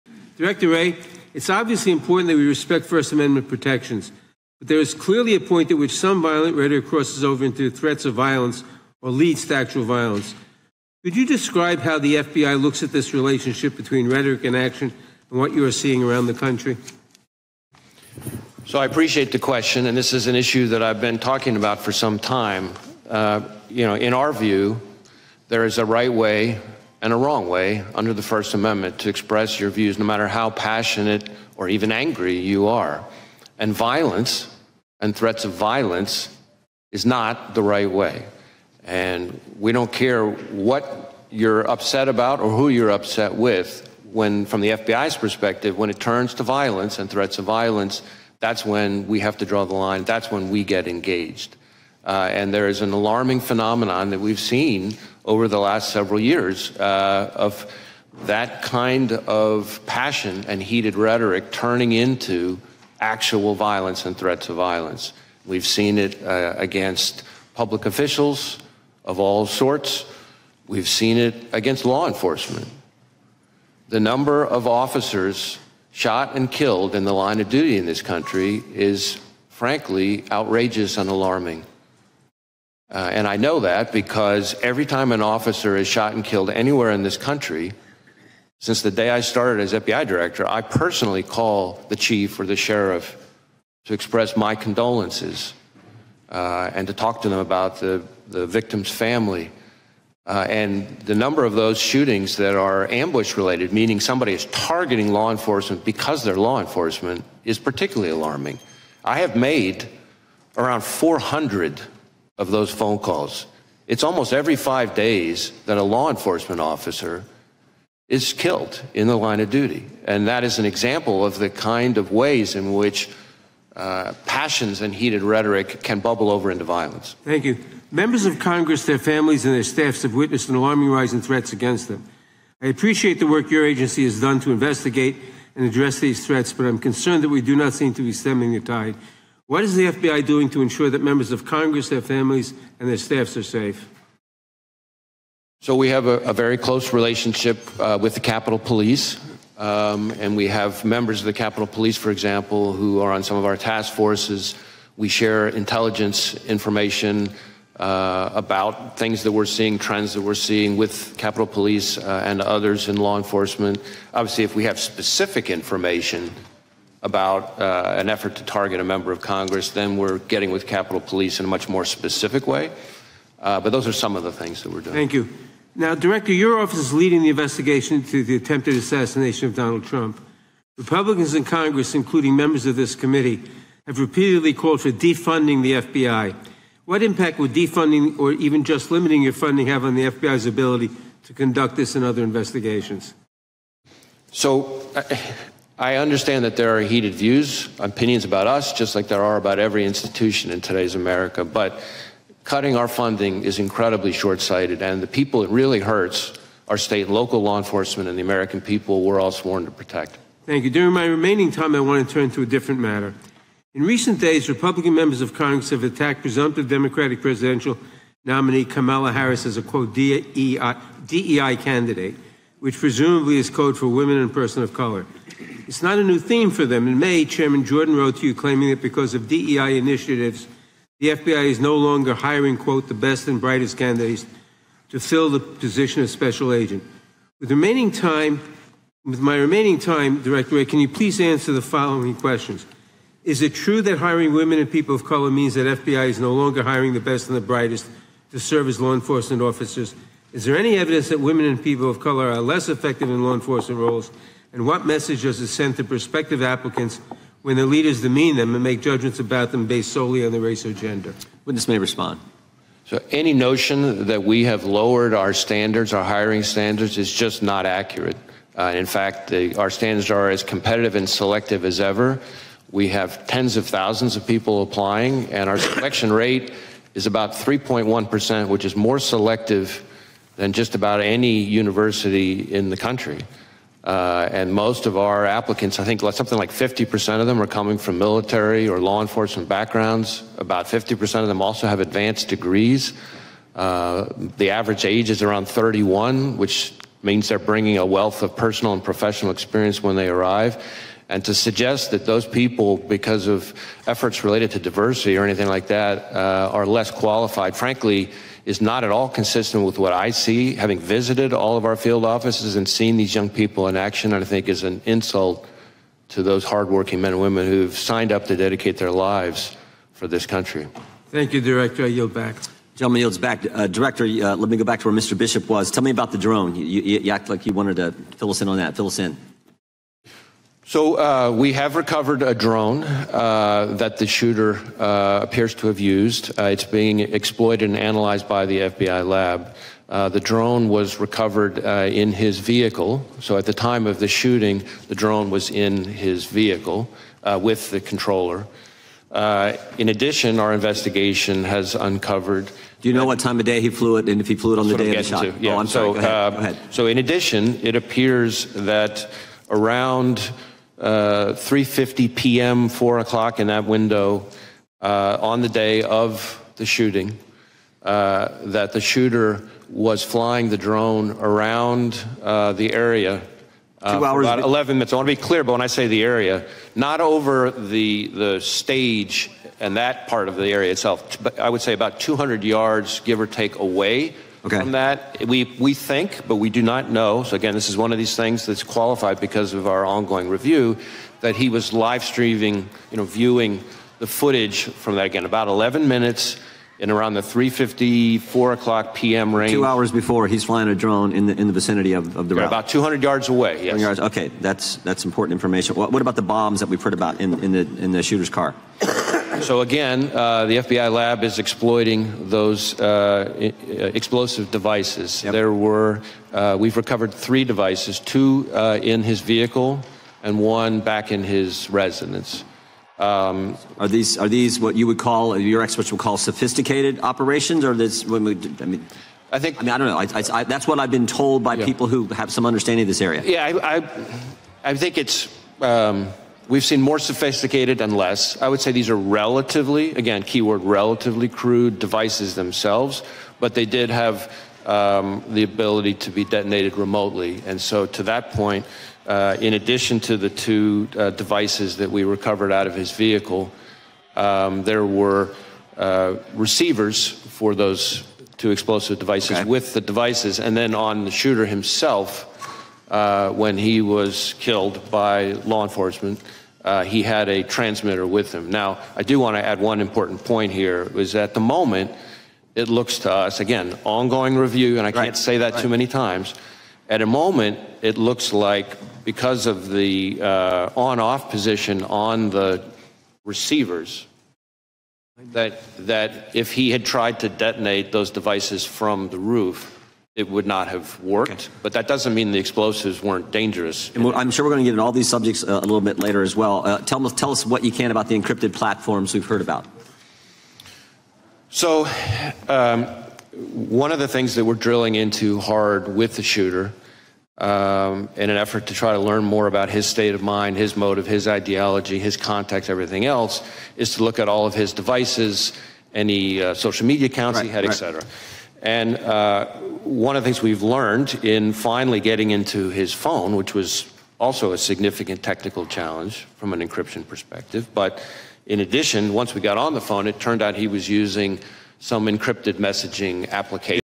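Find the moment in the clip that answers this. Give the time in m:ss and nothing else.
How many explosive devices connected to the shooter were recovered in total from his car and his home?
6:57.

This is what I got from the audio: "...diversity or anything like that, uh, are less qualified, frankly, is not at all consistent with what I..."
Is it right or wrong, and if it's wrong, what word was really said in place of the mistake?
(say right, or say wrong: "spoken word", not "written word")
right.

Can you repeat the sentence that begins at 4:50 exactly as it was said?
About 50% of them also have advanced degrees.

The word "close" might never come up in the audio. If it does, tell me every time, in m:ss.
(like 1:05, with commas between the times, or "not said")
2:26.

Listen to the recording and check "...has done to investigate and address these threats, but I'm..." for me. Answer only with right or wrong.
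right.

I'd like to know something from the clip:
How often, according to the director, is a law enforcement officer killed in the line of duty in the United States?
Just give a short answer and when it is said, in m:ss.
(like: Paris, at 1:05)
every 5 days, at 1:54.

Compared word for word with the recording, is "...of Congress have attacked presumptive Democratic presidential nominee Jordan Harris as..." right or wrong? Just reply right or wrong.
wrong.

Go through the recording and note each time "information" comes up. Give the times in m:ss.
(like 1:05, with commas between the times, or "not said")
2:36, 2:45, 6:45.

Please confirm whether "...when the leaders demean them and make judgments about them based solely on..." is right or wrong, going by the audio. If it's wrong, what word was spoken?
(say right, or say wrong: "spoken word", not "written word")
right.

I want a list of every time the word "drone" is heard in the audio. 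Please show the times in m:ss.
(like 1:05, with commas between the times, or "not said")
5:26, 5:32, 5:40, 5:44, 6:10, 6:40.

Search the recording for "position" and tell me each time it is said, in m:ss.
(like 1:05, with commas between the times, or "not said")
3:55, 8:01.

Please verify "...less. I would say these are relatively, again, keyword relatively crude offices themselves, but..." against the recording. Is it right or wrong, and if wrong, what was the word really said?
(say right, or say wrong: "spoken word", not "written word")
wrong: "devices", not "offices".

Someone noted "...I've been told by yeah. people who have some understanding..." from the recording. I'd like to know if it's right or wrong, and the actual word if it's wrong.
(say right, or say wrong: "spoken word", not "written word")
right.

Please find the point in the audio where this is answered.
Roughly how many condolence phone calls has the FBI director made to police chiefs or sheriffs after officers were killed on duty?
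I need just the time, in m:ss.
1:50.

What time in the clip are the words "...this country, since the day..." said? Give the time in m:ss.
1:27.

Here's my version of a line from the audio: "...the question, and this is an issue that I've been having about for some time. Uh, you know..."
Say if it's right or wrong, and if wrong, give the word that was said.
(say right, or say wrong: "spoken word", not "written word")
wrong: "talking", not "having".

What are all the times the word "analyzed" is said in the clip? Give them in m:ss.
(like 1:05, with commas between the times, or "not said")
5:37.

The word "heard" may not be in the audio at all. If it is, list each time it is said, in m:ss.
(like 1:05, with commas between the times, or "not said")
6:46, 8:19.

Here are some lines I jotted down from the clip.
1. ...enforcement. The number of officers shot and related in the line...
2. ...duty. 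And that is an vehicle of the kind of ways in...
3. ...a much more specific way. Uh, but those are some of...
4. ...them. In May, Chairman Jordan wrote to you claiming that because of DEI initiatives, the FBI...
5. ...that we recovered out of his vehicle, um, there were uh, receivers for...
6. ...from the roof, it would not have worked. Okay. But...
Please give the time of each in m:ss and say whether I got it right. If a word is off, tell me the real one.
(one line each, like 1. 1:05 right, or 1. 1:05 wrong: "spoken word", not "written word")
1. 1:12 wrong: "killed", not "related"
2. 1:59 wrong: "example", not "vehicle"
3. 2:51 right
4. 3:46 right
5. 7:31 right
6. 8:08 right.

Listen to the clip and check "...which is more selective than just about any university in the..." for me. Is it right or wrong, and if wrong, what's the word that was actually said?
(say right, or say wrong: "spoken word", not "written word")
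right.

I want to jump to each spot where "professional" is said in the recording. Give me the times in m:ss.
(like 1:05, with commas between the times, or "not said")
4:58.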